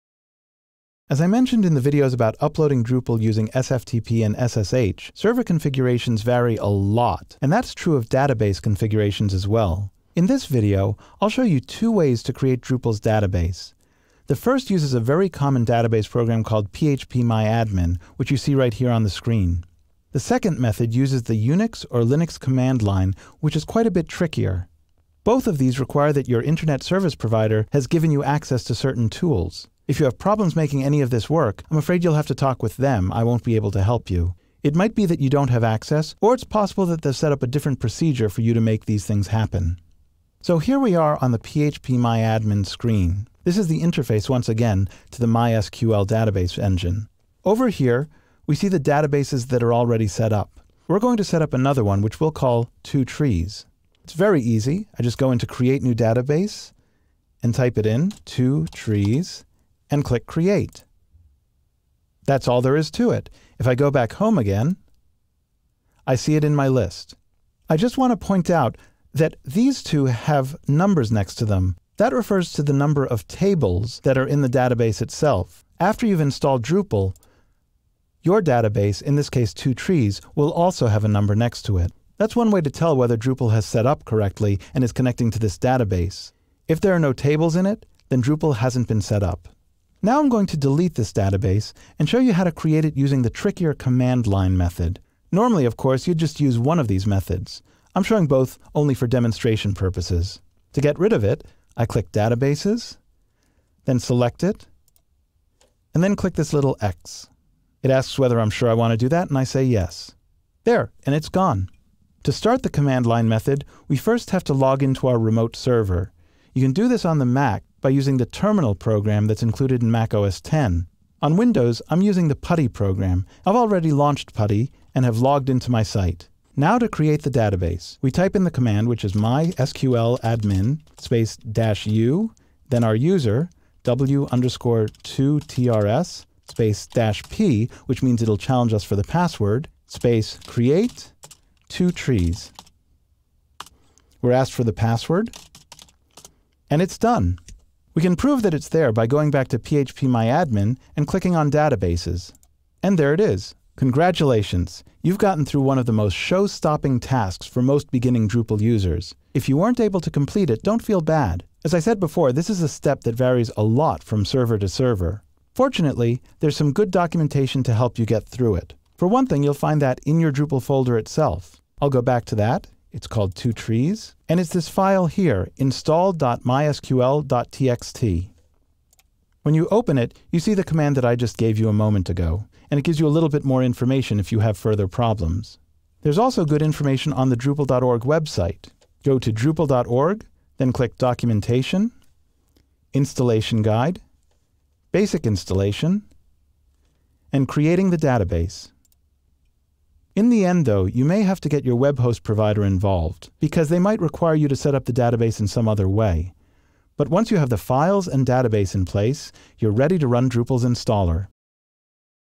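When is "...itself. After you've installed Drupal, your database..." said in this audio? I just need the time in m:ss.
1:15.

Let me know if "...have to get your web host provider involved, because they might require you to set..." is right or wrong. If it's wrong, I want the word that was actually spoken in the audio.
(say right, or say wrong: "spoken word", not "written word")
right.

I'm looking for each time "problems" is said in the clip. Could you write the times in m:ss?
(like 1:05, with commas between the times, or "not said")
0:30, 3:04.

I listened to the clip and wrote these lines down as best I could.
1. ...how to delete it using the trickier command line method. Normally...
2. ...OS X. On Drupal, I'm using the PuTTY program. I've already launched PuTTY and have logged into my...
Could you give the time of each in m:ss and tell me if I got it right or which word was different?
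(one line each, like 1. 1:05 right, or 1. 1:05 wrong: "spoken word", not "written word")
1. 1:32 wrong: "create", not "delete"
2. 2:00 wrong: "Windows", not "Drupal".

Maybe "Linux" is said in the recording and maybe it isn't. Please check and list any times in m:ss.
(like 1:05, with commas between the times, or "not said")
0:22.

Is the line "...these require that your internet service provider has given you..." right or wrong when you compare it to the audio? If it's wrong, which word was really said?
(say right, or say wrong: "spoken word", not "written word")
right.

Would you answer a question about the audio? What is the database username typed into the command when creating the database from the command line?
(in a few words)
w_2trs.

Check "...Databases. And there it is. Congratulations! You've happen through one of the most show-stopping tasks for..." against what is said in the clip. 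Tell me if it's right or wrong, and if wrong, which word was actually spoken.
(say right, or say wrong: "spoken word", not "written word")
wrong: "gotten", not "happen".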